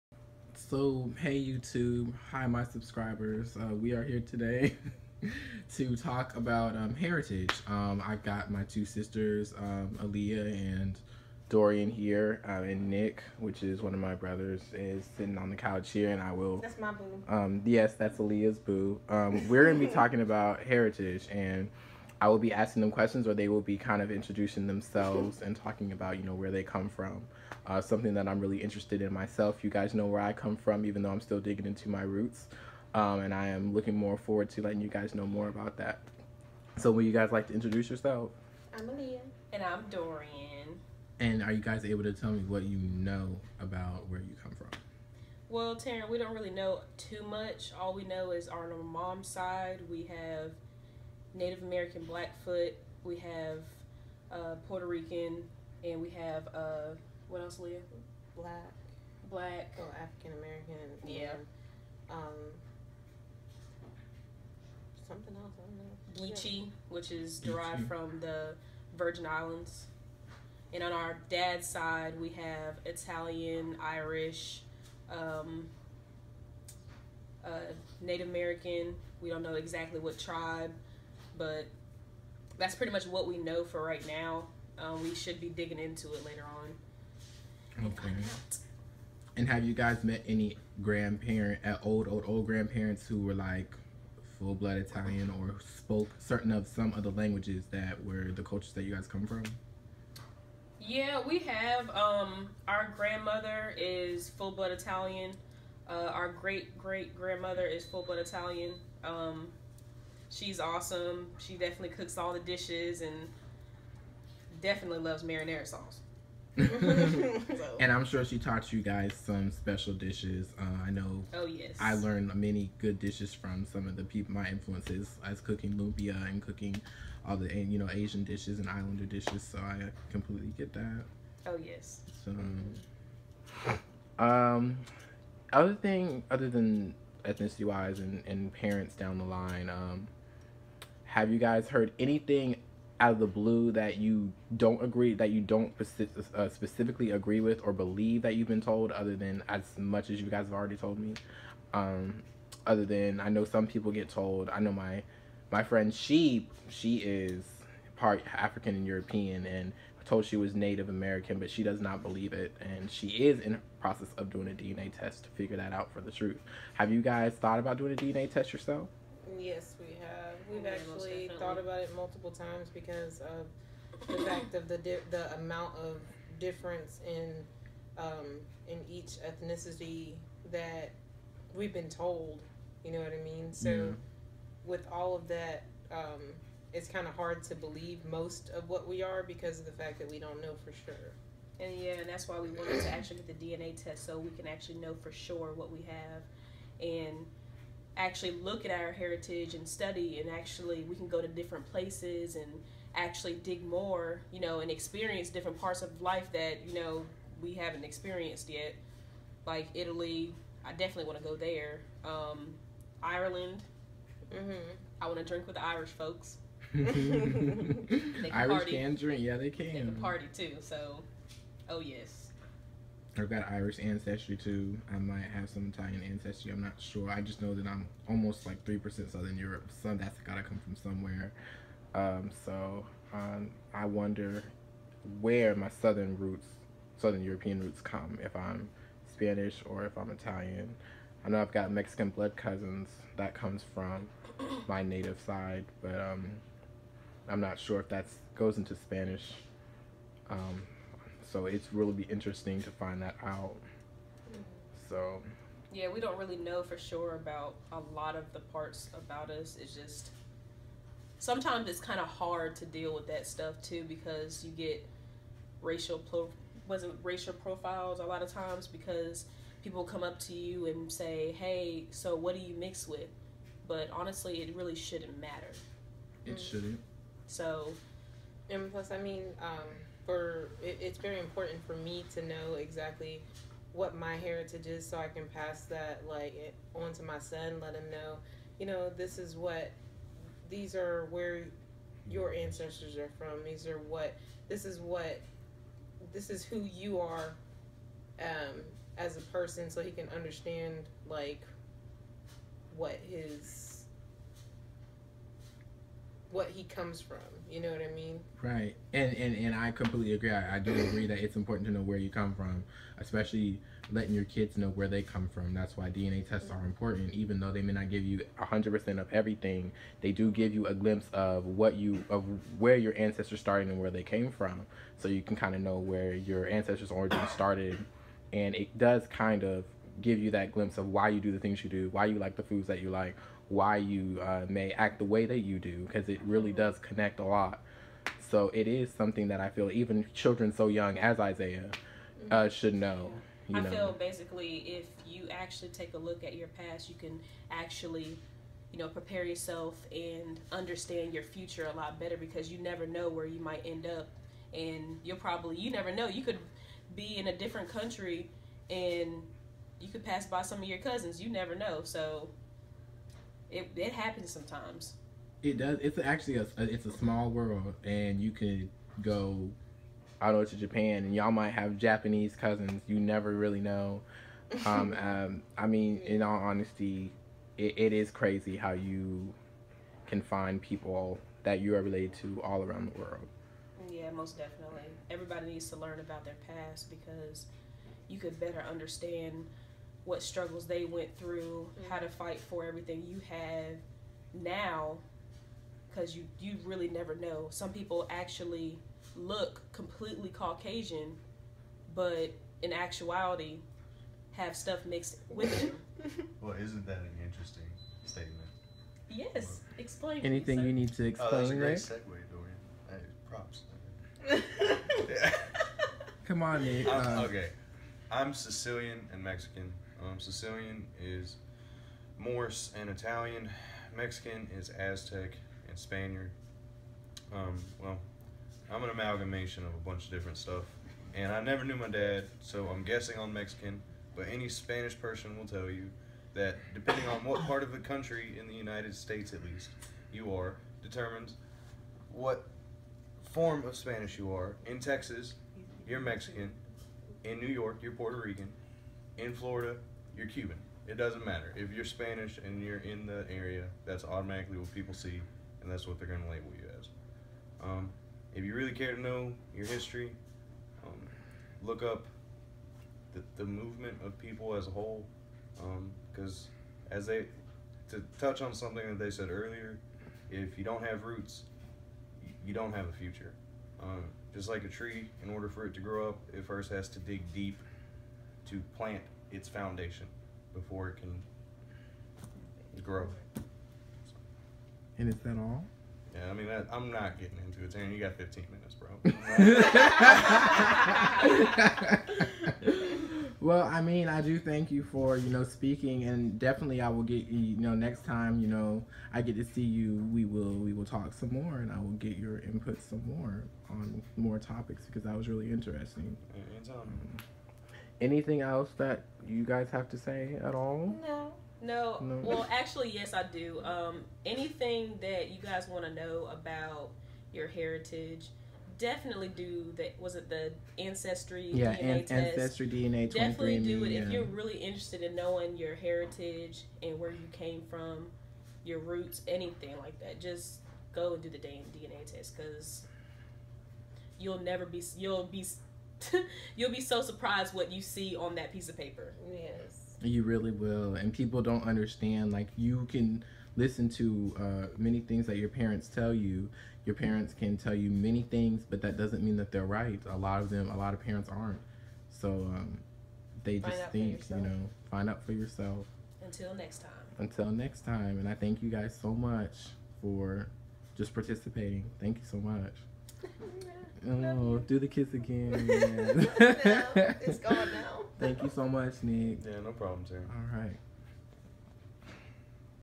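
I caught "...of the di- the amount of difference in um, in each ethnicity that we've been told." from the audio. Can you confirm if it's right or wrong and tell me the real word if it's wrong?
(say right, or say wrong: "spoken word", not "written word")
right.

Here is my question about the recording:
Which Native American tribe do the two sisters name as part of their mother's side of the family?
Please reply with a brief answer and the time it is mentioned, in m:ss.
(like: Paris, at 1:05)
Blackfoot, at 0:51.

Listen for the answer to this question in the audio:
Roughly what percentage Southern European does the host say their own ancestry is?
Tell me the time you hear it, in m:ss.
3:48.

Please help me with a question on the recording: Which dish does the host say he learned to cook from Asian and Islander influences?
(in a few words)
Lumpia.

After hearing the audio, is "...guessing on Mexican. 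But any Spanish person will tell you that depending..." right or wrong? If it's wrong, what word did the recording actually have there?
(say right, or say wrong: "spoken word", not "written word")
right.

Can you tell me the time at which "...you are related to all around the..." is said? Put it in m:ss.
6:21.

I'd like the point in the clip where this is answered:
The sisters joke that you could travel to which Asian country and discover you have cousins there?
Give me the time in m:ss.
6:10.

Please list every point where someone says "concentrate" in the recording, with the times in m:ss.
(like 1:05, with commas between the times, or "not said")
not said.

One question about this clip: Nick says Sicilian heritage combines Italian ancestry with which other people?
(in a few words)
Moors.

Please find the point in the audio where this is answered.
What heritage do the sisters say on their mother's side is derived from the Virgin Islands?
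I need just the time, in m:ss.
1:06.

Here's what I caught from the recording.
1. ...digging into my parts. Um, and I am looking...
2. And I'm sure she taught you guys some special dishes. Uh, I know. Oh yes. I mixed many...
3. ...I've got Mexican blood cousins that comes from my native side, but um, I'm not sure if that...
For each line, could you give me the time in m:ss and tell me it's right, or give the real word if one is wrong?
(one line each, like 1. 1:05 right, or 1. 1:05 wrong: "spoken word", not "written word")
1. 0:31 wrong: "roots", not "parts"
2. 1:57 wrong: "learned", not "mixed"
3. 4:01 right.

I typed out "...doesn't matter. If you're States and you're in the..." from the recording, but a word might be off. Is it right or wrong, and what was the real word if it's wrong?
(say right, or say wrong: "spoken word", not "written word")
wrong: "Spanish", not "States".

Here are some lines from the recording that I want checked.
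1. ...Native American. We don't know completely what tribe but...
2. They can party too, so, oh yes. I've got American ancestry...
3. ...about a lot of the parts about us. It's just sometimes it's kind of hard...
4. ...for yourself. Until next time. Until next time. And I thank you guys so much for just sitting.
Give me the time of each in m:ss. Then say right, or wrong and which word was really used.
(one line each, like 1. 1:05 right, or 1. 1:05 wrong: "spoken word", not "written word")
1. 1:18 wrong: "exactly", not "completely"
2. 3:39 wrong: "Irish", not "American"
3. 4:17 right
4. 9:15 wrong: "participating", not "sitting".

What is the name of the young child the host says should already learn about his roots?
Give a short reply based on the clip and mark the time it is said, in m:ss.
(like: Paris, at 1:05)
Isaiah, at 5:41.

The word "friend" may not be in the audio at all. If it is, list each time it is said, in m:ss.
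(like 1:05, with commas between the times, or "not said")
2:35.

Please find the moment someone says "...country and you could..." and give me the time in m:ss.
5:57.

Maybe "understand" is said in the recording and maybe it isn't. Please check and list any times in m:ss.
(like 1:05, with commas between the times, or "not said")
5:00, 5:50, 6:28, 9:01.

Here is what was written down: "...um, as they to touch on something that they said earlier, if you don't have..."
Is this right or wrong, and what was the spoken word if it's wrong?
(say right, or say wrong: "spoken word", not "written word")
right.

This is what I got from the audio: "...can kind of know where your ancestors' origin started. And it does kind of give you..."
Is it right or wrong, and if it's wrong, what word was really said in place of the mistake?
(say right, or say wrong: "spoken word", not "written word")
right.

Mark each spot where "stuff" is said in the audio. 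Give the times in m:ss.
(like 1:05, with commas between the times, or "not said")
4:23, 6:44, 7:10.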